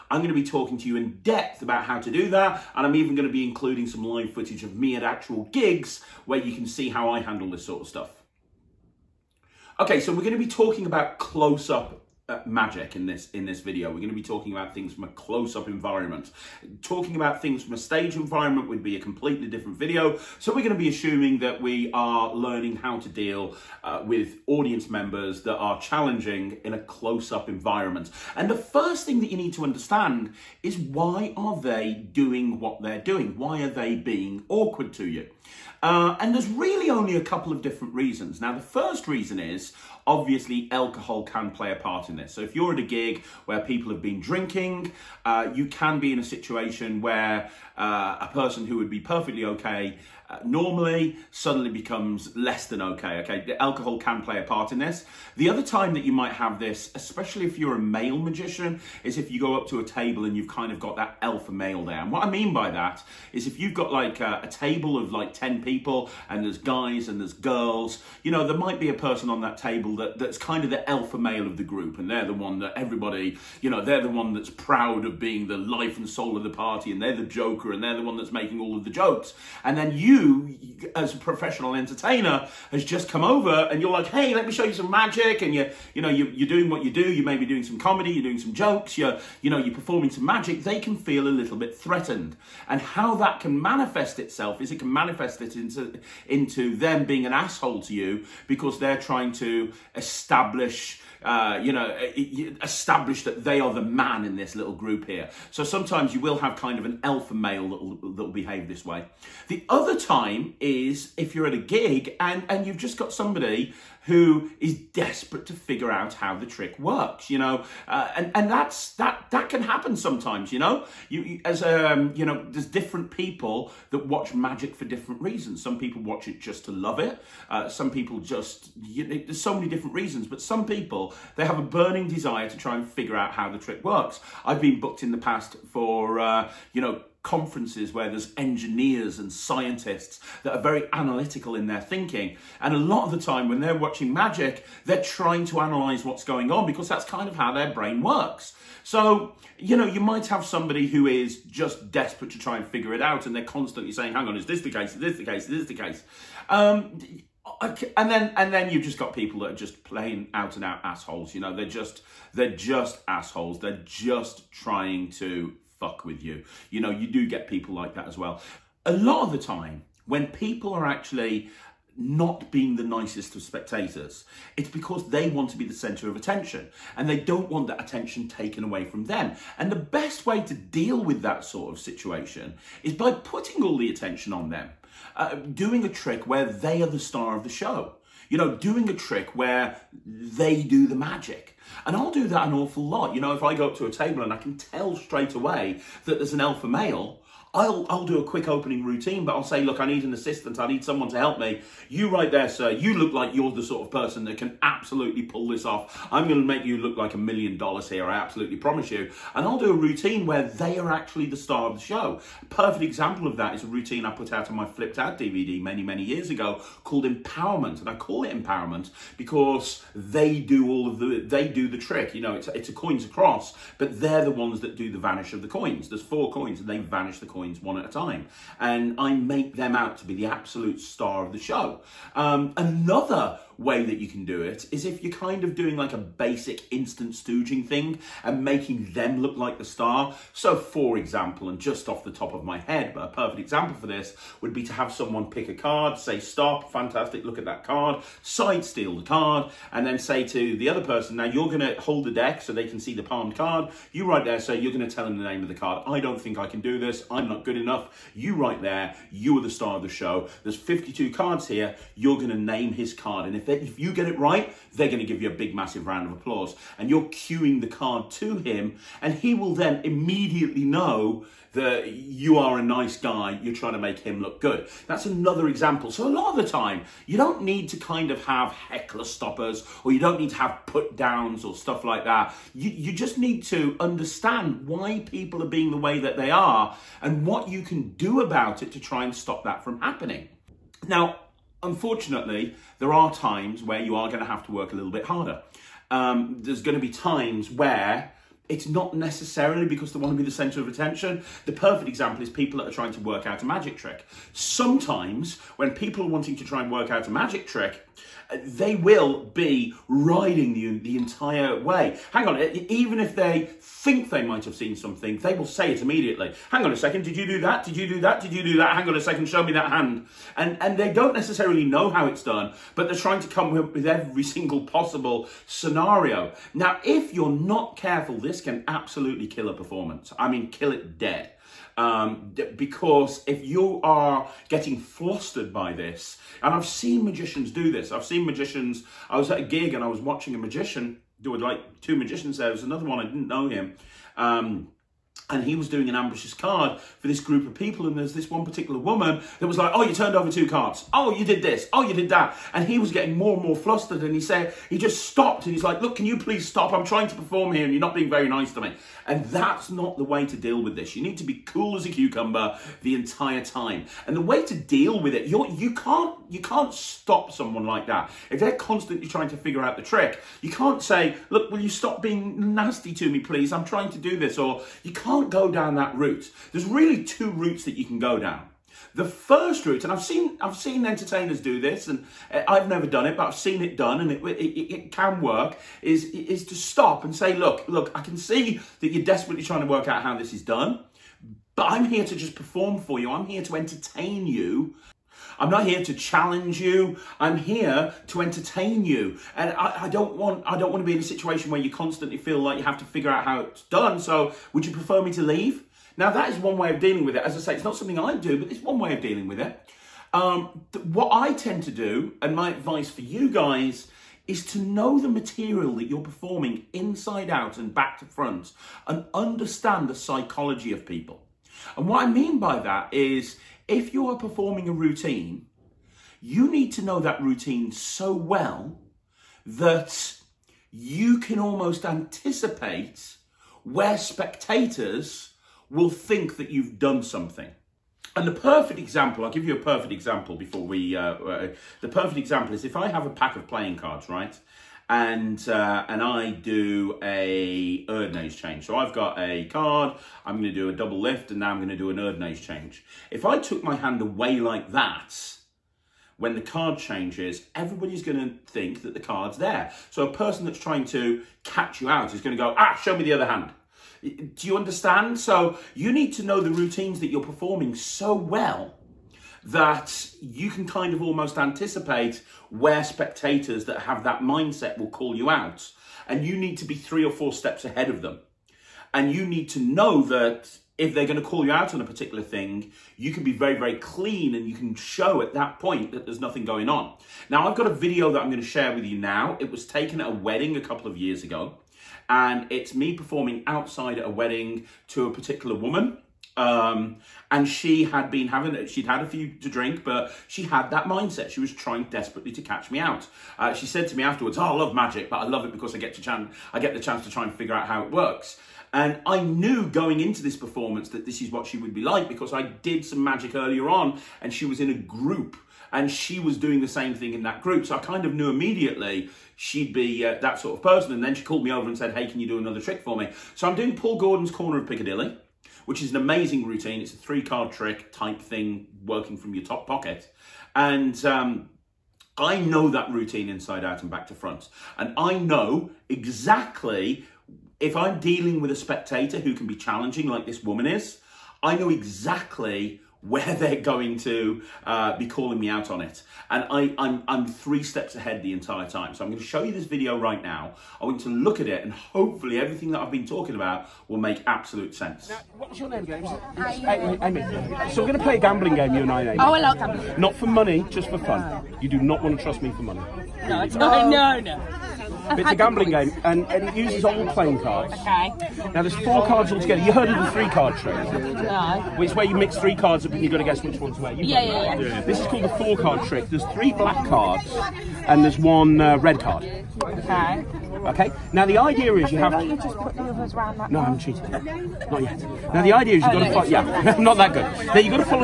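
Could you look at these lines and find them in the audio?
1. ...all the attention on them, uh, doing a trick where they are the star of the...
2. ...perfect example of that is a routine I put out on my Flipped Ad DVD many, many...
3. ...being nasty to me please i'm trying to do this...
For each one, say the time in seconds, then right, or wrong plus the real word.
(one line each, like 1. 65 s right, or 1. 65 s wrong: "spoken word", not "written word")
1. 183 s right
2. 212 s right
3. 372 s right.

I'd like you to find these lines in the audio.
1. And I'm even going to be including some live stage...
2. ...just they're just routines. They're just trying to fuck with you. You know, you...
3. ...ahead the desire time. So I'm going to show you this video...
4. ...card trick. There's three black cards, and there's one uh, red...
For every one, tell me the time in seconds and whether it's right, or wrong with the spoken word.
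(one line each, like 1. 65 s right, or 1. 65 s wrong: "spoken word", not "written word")
1. 2 s wrong: "footage", not "stage"
2. 161 s wrong: "assholes", not "routines"
3. 547 s wrong: "entire", not "desire"
4. 575 s right.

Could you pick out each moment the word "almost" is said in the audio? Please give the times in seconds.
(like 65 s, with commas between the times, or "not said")
431 s, 471 s.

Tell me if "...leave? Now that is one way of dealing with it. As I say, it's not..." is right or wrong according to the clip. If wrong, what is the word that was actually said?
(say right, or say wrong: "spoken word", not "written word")
right.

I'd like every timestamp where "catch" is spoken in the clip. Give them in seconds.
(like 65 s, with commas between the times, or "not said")
461 s, 502 s.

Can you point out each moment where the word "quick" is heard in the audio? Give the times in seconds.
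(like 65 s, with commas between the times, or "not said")
198 s.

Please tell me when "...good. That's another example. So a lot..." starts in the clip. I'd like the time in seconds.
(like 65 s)
274 s.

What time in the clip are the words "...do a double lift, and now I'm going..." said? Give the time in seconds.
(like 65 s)
450 s.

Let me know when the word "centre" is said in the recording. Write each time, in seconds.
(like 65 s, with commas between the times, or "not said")
175 s, 300 s.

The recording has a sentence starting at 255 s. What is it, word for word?
I don't think I can do this.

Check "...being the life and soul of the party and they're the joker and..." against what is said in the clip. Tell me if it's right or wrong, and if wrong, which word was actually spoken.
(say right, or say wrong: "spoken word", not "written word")
right.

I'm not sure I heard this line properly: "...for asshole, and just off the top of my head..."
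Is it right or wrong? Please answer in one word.
wrong.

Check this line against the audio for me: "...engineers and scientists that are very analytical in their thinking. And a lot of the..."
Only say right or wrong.
right.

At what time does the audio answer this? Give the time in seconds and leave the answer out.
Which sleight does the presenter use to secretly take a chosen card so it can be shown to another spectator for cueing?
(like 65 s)
248 s.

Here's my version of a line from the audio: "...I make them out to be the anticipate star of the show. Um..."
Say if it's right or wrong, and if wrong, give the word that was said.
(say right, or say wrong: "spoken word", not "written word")
wrong: "absolute", not "anticipate".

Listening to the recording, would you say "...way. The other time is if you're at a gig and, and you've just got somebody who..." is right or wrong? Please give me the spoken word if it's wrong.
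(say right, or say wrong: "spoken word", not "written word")
right.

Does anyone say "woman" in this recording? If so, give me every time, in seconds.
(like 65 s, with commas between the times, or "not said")
348 s, 495 s, 540 s.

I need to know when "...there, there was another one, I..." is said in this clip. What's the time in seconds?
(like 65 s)
342 s.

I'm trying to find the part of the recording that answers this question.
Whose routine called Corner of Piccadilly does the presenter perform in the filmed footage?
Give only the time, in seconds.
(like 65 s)
523 s.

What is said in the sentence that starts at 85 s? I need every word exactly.
And you, you know, you, are doing what you do.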